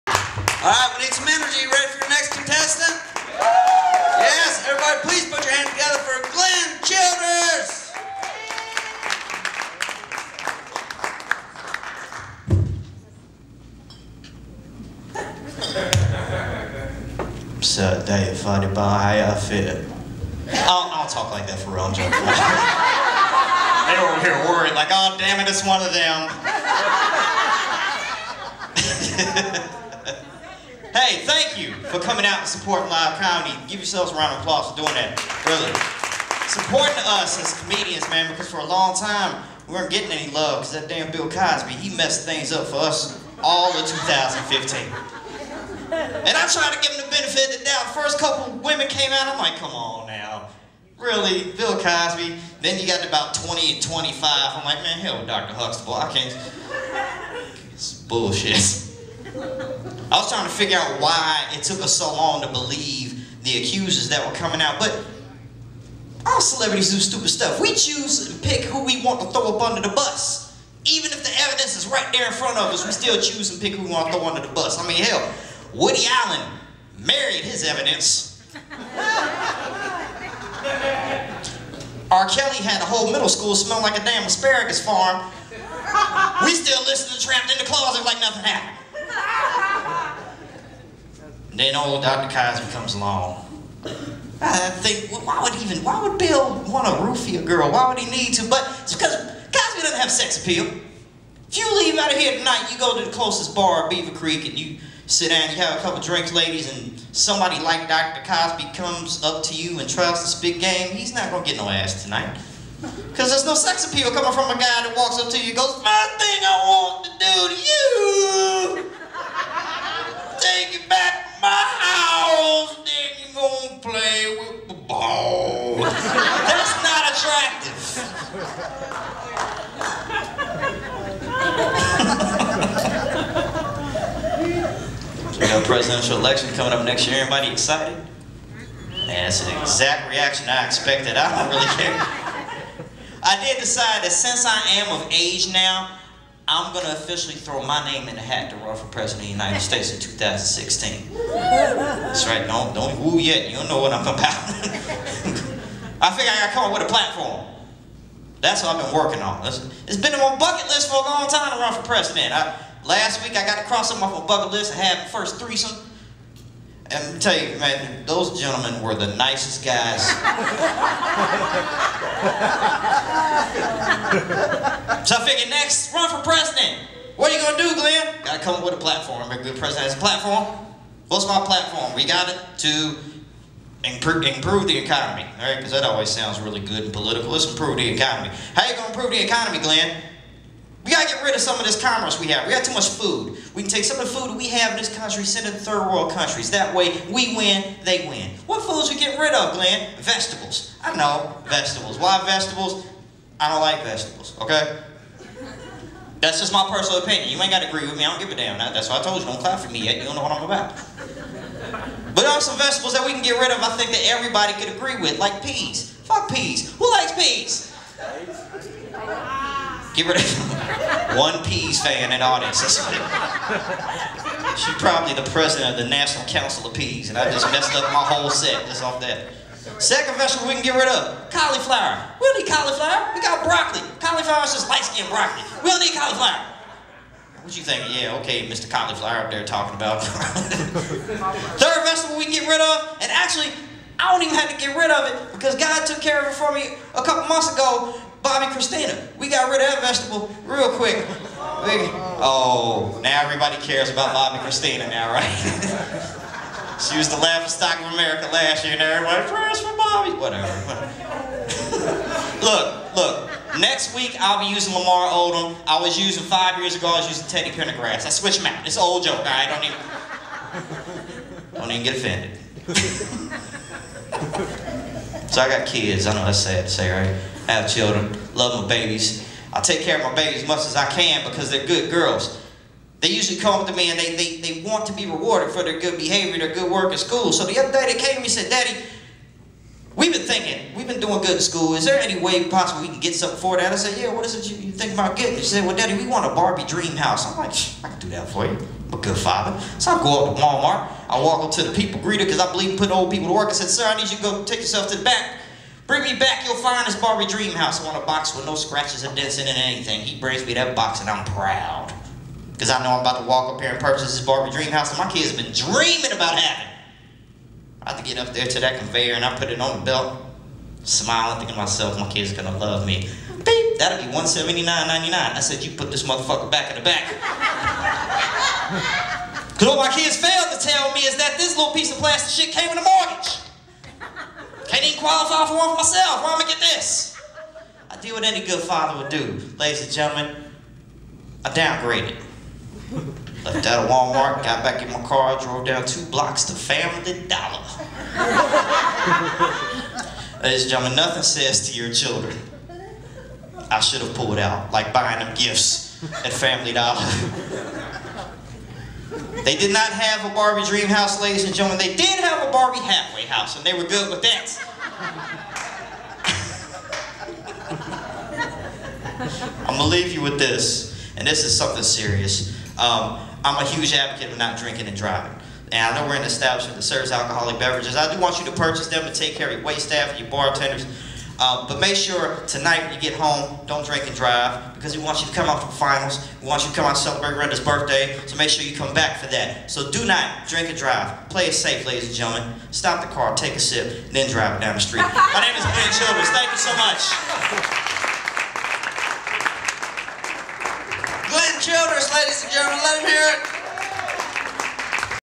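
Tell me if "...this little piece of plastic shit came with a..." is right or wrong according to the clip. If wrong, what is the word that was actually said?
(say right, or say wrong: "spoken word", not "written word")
right.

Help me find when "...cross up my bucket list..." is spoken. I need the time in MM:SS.
02:43.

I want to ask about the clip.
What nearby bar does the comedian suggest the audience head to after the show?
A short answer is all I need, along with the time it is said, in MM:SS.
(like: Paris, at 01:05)
Beaver Creek, at 01:43.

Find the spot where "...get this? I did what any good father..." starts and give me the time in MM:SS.
05:36.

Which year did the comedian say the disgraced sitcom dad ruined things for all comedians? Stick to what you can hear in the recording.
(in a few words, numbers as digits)
2015.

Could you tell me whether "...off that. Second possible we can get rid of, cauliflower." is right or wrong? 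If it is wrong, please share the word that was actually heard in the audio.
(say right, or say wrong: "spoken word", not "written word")
wrong: "vegetable", not "possible".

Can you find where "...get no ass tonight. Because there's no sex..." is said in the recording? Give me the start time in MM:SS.
01:51.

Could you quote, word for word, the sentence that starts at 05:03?
I said, sir, I need you to go take yourself to the back Bring me back your finest Barbie dream house.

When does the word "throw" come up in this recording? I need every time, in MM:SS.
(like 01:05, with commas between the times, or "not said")
01:09, 01:14, 02:27.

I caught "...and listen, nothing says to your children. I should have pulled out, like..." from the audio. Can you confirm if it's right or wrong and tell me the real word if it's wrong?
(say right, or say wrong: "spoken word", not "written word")
wrong: "gentlemen", not "listen".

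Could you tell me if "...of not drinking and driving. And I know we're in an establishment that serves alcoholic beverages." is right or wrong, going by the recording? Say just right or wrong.
right.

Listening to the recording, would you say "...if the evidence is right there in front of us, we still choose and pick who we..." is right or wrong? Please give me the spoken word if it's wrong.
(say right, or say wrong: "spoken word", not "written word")
right.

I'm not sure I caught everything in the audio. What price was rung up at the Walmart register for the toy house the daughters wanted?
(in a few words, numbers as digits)
$179.99.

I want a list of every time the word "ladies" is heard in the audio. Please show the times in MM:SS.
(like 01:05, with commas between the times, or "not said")
01:46, 05:39, 05:50, 06:01, 06:31, 06:42.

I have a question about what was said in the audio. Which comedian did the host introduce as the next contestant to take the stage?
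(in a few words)
Glenn Childers.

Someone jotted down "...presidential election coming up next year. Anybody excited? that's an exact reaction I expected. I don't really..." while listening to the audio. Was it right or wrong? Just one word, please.
right.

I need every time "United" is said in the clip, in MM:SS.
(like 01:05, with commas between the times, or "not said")
02:29.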